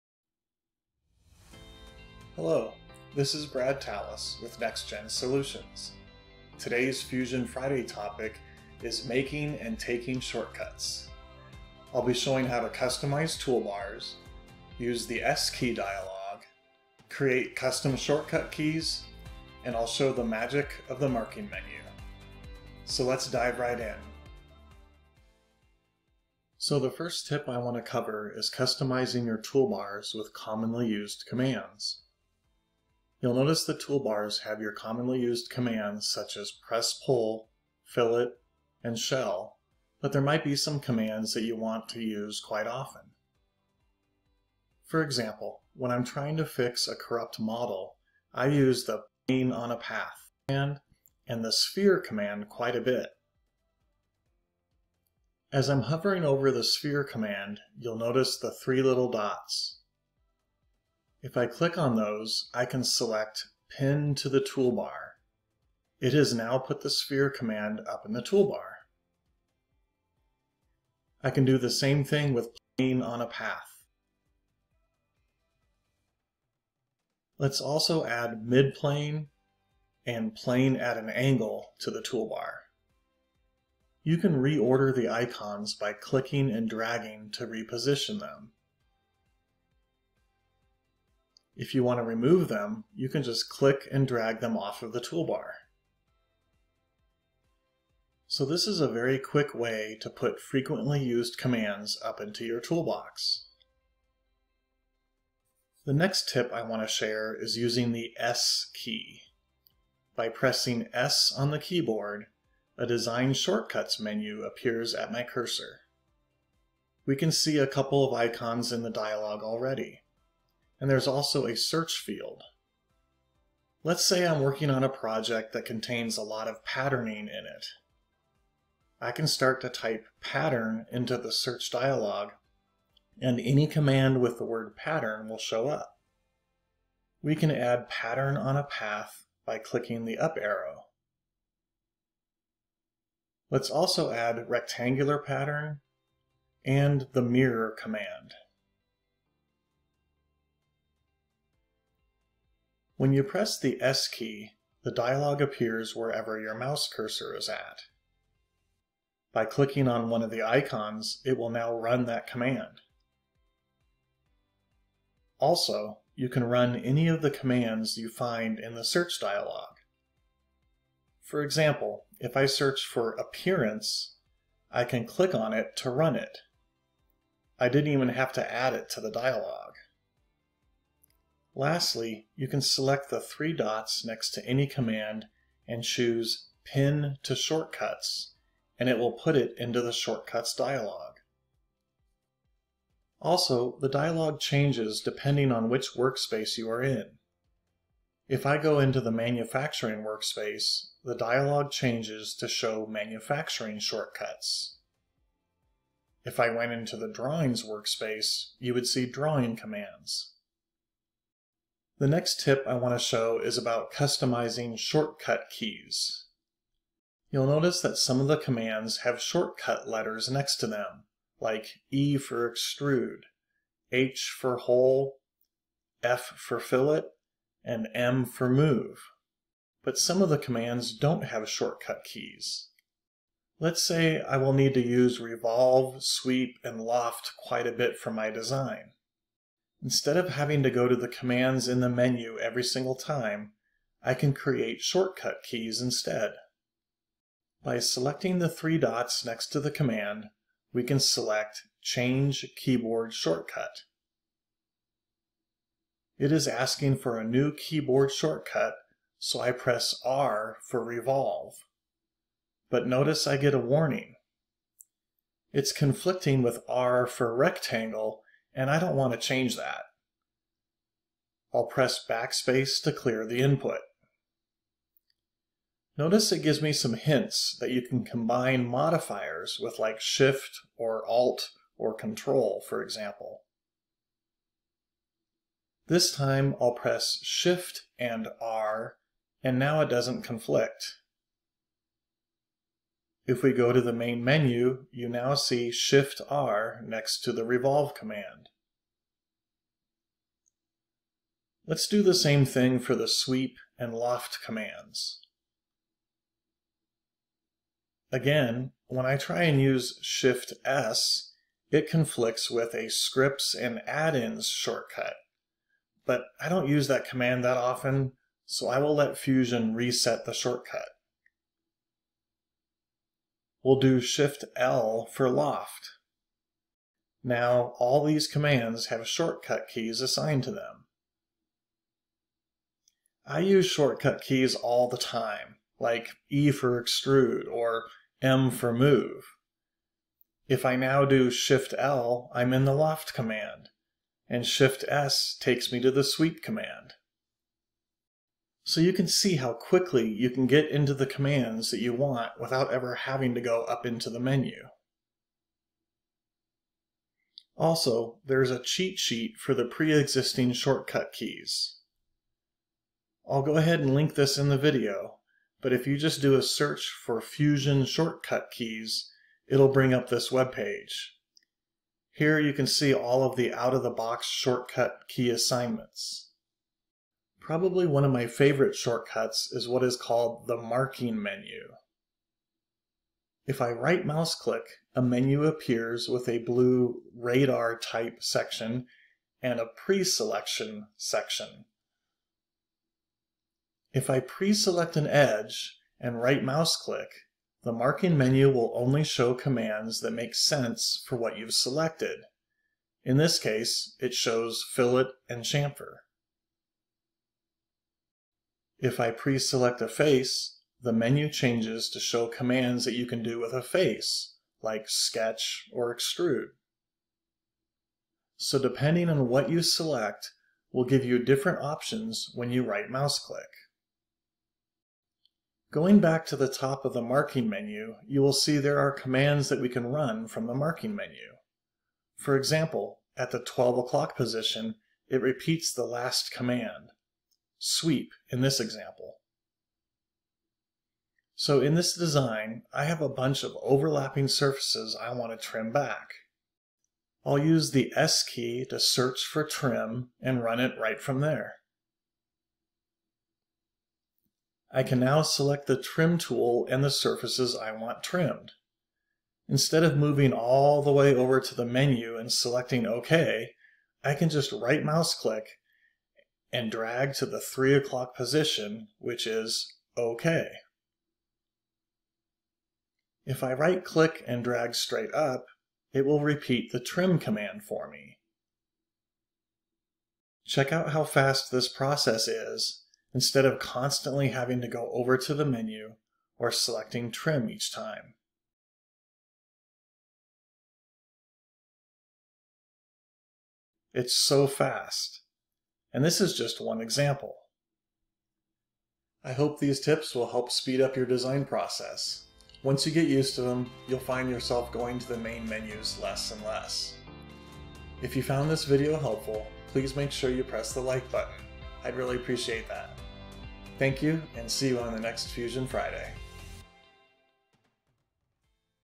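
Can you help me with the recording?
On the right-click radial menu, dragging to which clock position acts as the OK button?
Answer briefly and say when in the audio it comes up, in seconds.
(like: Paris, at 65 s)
3 o'clock, at 467 s.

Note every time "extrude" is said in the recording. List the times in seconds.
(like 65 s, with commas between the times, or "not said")
222 s, 336 s, 415 s.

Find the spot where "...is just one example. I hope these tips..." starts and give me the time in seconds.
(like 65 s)
496 s.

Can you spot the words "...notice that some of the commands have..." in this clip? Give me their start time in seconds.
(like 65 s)
217 s.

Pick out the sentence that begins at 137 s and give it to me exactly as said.
We can add pattern on a path by clicking the up arrow.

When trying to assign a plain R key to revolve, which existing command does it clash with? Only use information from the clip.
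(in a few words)
Rectangle.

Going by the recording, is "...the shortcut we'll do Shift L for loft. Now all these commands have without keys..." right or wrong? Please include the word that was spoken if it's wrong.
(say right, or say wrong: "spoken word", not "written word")
wrong: "shortcut", not "without".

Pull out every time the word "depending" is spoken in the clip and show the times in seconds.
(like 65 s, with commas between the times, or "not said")
195 s, 418 s.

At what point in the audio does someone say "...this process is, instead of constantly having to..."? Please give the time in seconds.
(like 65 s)
481 s.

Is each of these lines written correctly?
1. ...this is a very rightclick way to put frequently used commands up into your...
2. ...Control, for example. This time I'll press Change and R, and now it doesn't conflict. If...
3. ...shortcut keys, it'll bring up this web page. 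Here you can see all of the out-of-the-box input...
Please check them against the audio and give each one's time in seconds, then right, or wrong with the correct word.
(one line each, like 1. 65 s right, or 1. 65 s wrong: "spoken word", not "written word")
1. 98 s wrong: "quick", not "rightclick"
2. 281 s wrong: "Shift", not "Change"
3. 367 s wrong: "shortcut", not "input".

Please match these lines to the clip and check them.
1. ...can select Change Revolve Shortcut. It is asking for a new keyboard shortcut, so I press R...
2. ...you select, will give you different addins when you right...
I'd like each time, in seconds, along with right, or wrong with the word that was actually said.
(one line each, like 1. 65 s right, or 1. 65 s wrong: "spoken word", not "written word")
1. 250 s wrong: "Keyboard", not "Revolve"
2. 419 s wrong: "options", not "addins".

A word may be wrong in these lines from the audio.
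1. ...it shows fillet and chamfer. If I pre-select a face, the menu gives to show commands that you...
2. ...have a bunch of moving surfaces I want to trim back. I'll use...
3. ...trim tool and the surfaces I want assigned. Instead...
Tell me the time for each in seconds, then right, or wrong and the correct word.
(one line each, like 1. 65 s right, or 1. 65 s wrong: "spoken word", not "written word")
1. 403 s wrong: "changes", not "gives"
2. 442 s wrong: "overlapping", not "moving"
3. 455 s wrong: "trimmed", not "assigned".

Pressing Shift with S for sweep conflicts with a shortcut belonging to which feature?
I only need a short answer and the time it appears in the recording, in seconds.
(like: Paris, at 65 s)
scripts and add-ins, at 312 s.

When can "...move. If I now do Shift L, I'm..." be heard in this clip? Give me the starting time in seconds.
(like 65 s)
338 s.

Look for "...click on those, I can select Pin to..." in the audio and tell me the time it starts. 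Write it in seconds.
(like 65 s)
61 s.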